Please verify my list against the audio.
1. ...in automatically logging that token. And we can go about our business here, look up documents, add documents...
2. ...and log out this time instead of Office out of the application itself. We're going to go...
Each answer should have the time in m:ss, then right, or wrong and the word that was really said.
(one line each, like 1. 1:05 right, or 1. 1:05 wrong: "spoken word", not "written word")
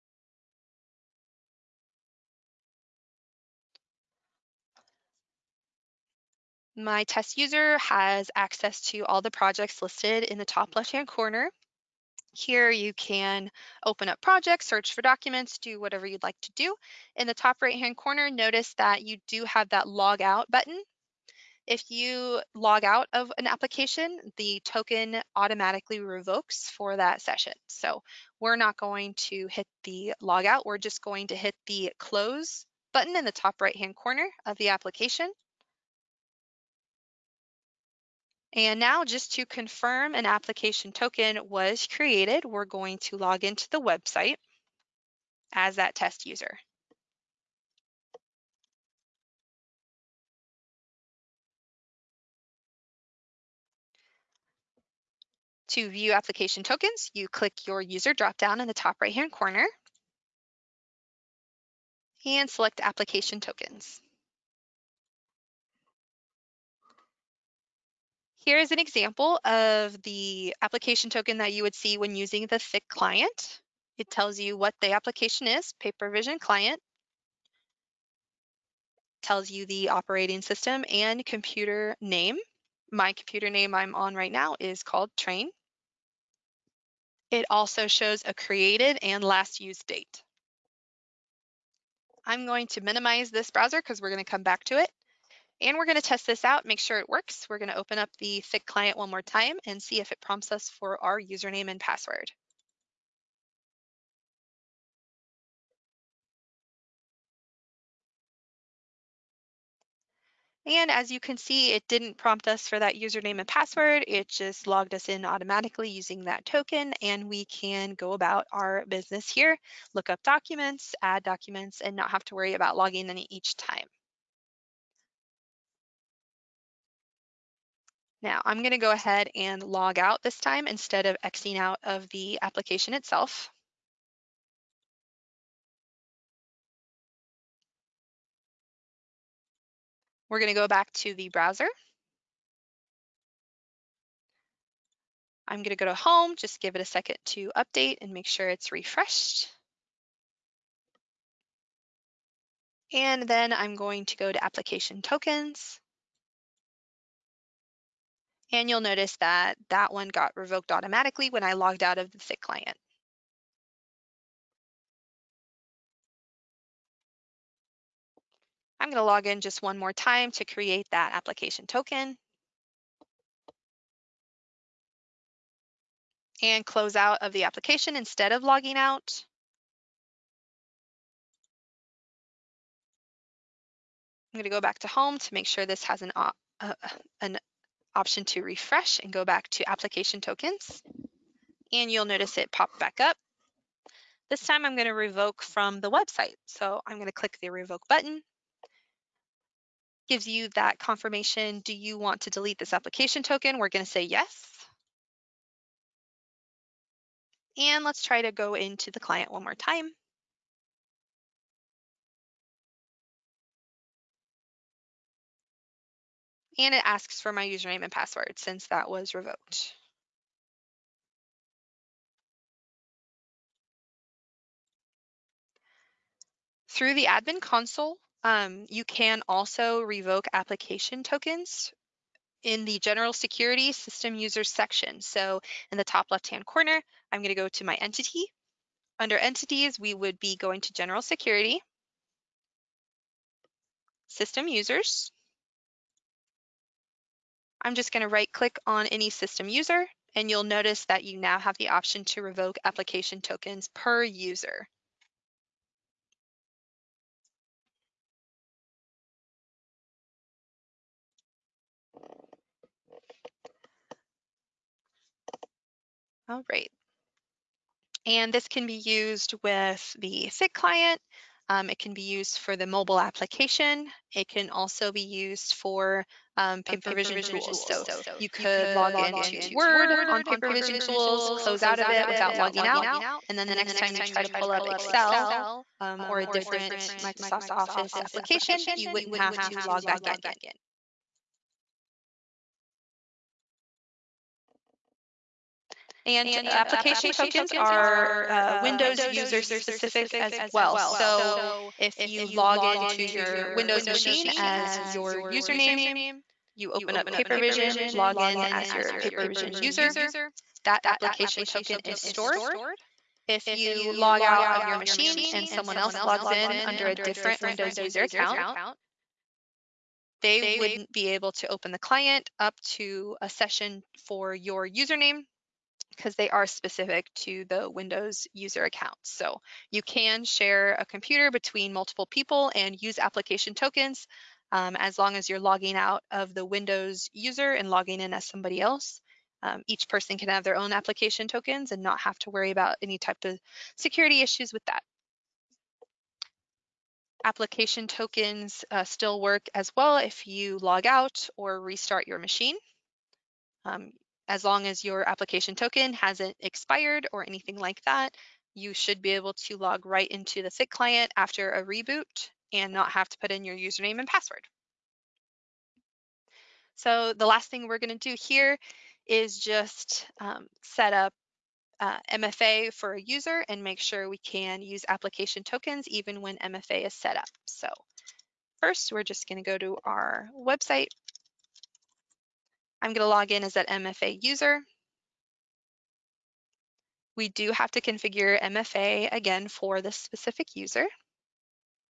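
1. 1:55 wrong: "using", not "logging"
2. 2:09 wrong: "Xing", not "Office".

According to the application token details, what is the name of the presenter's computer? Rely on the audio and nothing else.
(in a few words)
Train.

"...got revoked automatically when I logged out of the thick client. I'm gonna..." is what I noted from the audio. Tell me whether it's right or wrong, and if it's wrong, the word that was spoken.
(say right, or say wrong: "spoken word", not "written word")
right.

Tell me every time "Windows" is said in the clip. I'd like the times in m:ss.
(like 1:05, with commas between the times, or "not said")
4:58, 5:03, 5:17, 5:27, 5:36.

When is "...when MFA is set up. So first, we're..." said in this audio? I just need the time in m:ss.
6:16.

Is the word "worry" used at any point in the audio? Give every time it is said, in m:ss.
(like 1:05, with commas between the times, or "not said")
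2:02, 5:42.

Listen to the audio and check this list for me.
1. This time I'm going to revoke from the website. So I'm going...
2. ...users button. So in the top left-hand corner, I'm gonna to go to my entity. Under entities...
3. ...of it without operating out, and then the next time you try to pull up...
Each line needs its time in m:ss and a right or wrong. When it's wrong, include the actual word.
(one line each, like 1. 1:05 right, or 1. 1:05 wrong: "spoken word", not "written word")
1. 3:14 right
2. 3:54 wrong: "section", not "button"
3. 4:41 wrong: "logging", not "operating".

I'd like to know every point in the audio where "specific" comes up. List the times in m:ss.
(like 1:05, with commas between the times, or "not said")
4:59, 5:26, 6:29.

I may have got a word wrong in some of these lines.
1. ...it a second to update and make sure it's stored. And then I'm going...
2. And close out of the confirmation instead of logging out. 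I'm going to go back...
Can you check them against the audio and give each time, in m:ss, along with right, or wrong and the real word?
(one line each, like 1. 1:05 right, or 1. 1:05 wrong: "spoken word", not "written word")
1. 2:26 wrong: "refreshed", not "stored"
2. 2:56 wrong: "application", not "confirmation".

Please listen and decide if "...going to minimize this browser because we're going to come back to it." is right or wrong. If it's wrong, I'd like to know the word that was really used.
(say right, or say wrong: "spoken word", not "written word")
right.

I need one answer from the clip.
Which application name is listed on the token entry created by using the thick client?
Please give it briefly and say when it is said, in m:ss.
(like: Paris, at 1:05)
PaperVision client, at 1:15.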